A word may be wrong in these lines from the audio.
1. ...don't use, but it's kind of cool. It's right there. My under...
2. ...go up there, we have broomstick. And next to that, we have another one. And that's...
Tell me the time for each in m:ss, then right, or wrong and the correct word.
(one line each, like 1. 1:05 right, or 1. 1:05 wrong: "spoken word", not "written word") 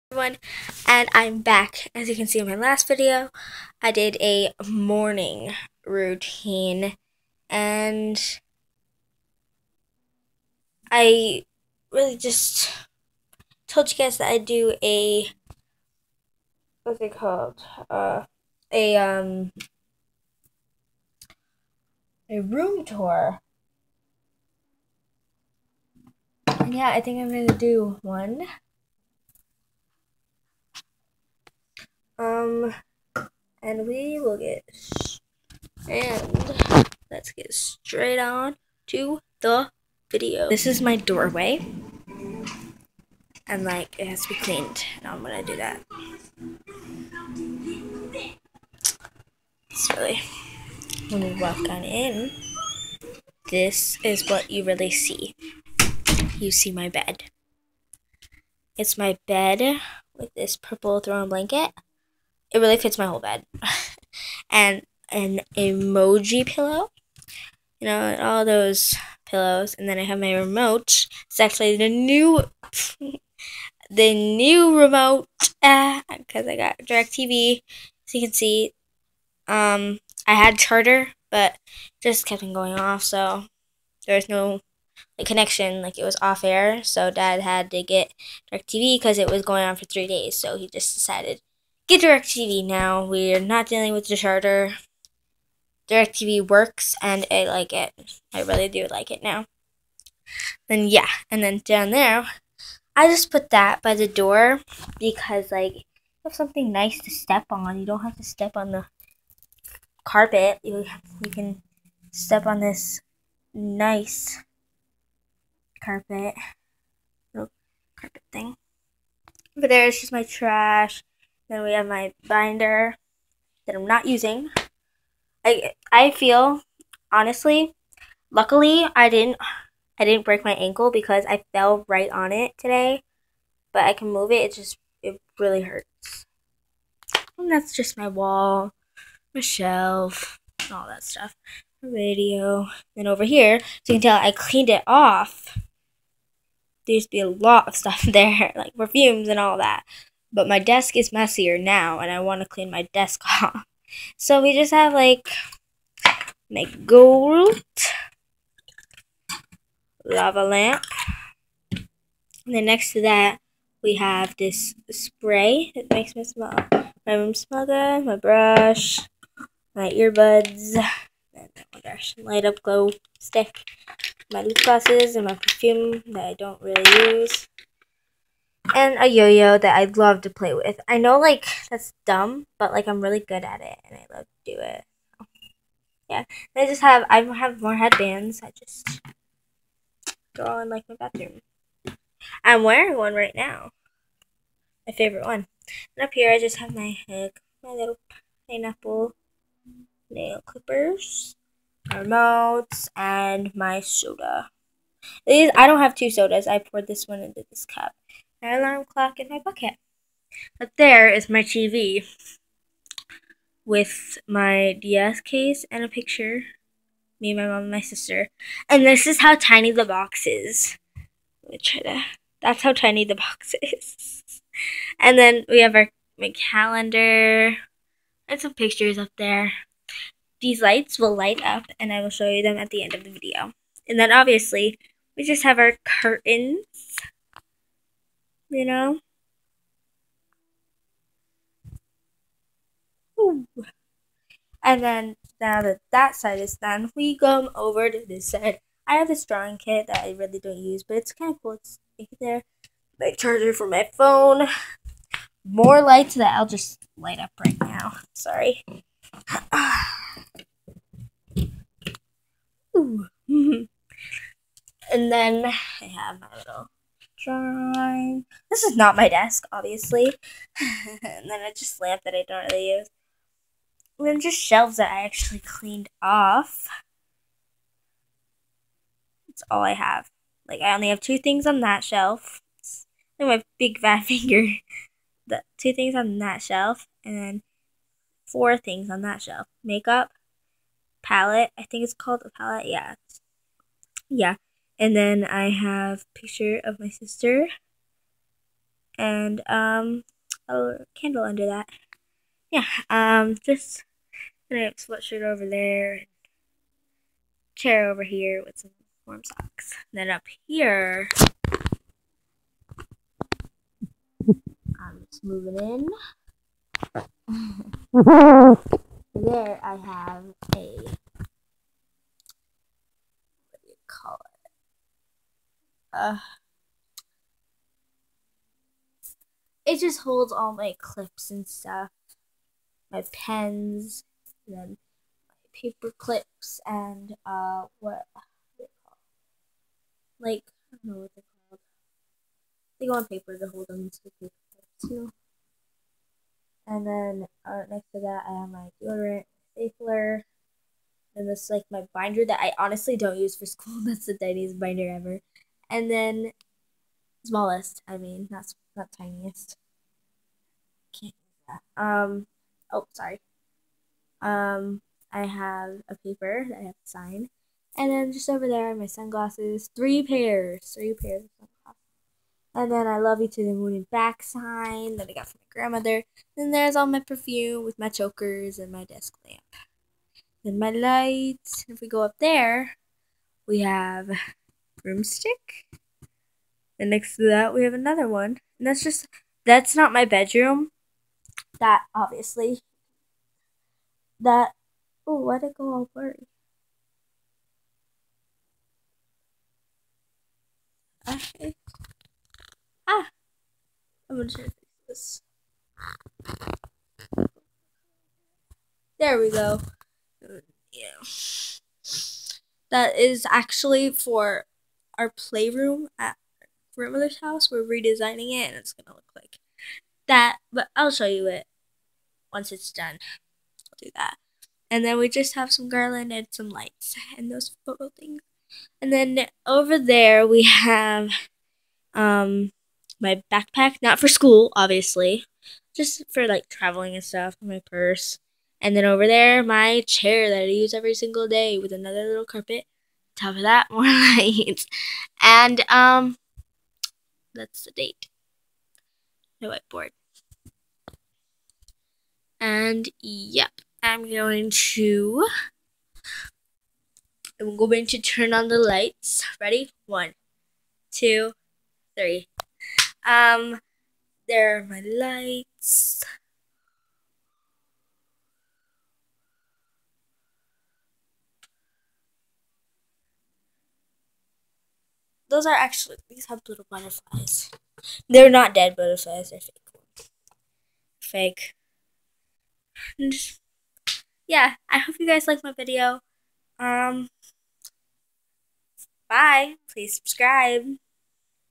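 1. 4:10 wrong: "charger", not "under"
2. 6:21 right.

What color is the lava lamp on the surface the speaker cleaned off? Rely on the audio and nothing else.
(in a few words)
Gold.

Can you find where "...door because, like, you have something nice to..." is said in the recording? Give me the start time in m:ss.
1:44.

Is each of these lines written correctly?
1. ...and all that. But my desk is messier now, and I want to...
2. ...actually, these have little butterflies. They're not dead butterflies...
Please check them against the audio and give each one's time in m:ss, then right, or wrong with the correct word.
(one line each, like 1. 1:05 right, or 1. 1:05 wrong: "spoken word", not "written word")
1. 2:29 right
2. 7:55 right.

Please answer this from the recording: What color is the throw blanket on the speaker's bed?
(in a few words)
Purple.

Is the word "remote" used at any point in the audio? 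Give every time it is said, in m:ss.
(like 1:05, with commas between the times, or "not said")
1:10, 1:14, 3:22.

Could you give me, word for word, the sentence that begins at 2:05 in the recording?
I I feel honestly, luckily I didn't I didn't break my ankle because I fell right on it today.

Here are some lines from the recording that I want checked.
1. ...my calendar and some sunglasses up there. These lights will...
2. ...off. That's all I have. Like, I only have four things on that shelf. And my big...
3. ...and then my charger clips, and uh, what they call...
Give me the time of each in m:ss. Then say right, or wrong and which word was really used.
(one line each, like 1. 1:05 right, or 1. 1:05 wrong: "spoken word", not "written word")
1. 3:46 wrong: "pictures", not "sunglasses"
2. 4:36 wrong: "two", not "four"
3. 5:34 wrong: "paper", not "charger".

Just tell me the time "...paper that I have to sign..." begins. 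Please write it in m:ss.
6:06.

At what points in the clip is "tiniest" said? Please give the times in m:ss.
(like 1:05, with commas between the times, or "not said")
5:54, 5:58.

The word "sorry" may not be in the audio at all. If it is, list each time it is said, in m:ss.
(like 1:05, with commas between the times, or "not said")
4:18, 6:02.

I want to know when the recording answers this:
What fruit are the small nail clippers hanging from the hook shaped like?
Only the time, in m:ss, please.
3:18.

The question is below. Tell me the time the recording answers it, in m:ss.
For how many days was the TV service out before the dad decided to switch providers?
1:29.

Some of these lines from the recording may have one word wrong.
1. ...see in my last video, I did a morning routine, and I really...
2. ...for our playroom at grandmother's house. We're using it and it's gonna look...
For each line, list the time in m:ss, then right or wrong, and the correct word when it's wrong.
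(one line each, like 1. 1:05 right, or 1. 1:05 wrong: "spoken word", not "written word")
1. 0:02 right
2. 6:53 wrong: "redesigning", not "using".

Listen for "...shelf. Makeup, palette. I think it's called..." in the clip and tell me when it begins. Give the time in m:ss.
4:49.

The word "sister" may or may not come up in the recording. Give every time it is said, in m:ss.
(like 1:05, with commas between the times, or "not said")
3:37, 4:56.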